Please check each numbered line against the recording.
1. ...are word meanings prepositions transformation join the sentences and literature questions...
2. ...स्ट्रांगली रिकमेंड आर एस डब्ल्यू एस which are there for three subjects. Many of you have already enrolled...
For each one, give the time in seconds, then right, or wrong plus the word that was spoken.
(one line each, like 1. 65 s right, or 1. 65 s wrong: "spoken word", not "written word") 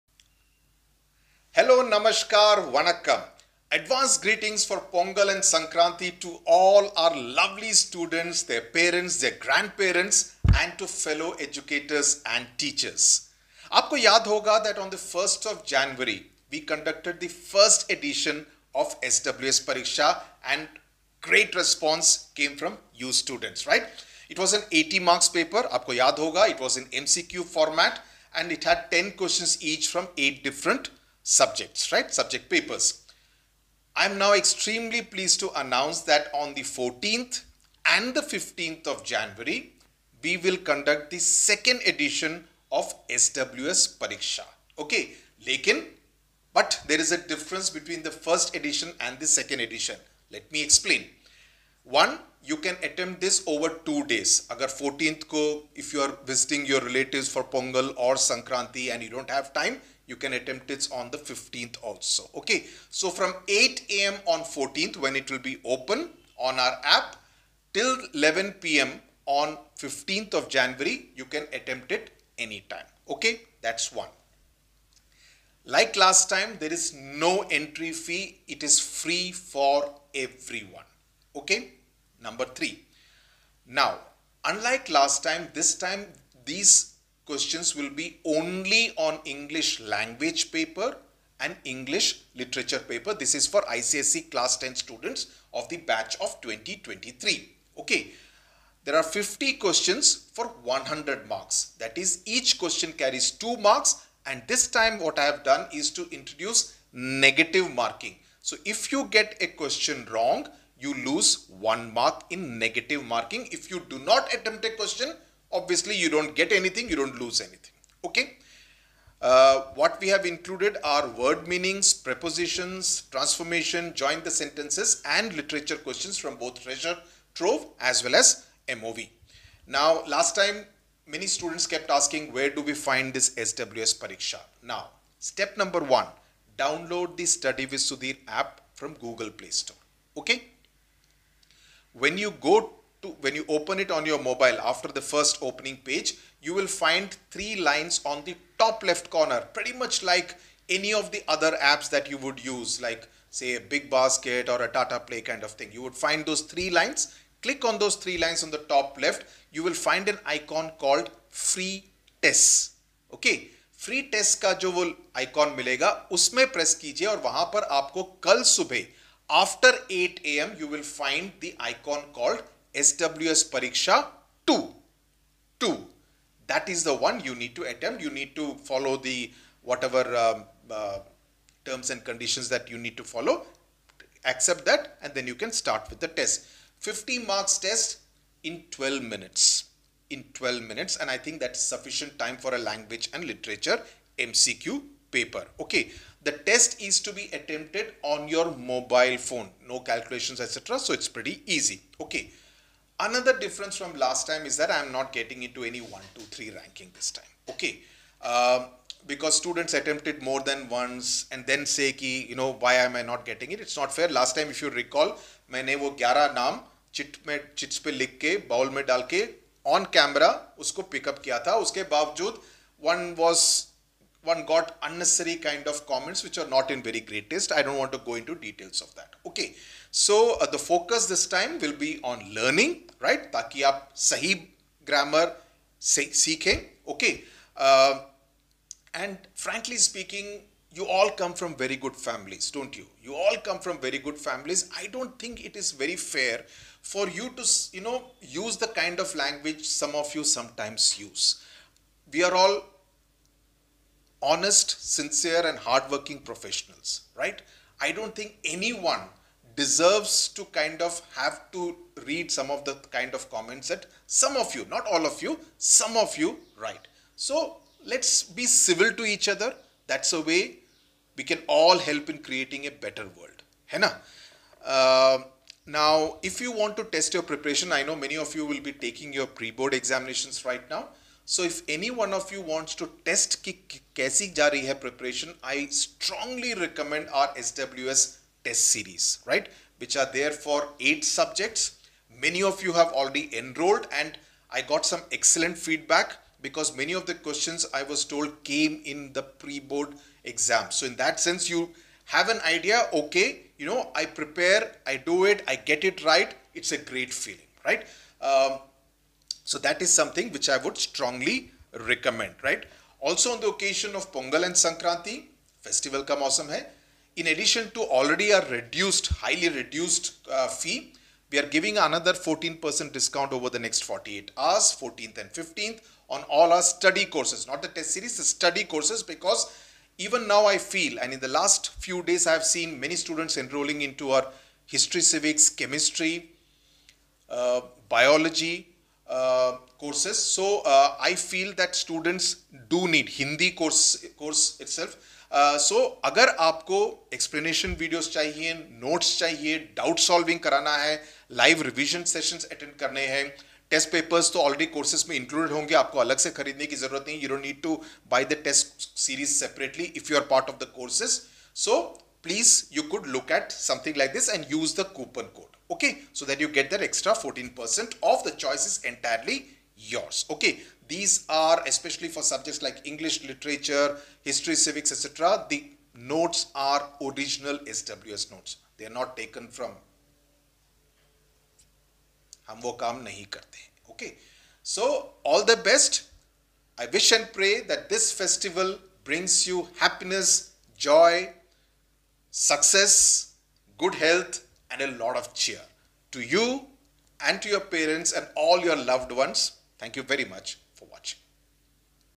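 1. 120 s right
2. 285 s wrong: "eight", not "three".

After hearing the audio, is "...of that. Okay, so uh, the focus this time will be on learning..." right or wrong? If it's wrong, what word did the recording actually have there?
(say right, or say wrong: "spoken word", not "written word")
right.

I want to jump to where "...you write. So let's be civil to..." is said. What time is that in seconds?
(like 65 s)
266 s.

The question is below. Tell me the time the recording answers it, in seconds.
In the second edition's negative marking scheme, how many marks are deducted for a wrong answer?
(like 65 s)
110 s.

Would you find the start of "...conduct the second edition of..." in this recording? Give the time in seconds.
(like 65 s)
40 s.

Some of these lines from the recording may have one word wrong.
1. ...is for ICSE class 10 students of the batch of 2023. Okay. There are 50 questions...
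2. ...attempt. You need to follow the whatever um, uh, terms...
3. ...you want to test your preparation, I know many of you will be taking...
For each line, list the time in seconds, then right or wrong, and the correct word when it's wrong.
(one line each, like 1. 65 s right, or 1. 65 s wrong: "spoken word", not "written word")
1. 93 s right
2. 177 s right
3. 276 s right.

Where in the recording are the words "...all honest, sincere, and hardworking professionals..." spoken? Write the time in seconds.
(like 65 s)
252 s.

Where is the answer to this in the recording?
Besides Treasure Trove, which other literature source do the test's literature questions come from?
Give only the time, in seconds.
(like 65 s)
128 s.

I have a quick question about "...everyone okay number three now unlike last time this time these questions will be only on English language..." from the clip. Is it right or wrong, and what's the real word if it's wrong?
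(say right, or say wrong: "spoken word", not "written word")
right.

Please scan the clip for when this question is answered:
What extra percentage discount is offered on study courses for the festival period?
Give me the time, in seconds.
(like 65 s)
322 s.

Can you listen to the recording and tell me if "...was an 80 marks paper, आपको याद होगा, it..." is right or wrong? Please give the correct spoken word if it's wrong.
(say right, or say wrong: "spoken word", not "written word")
right.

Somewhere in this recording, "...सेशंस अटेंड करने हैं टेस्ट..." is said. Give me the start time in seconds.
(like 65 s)
352 s.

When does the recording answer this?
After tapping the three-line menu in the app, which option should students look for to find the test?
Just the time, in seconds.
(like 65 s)
161 s.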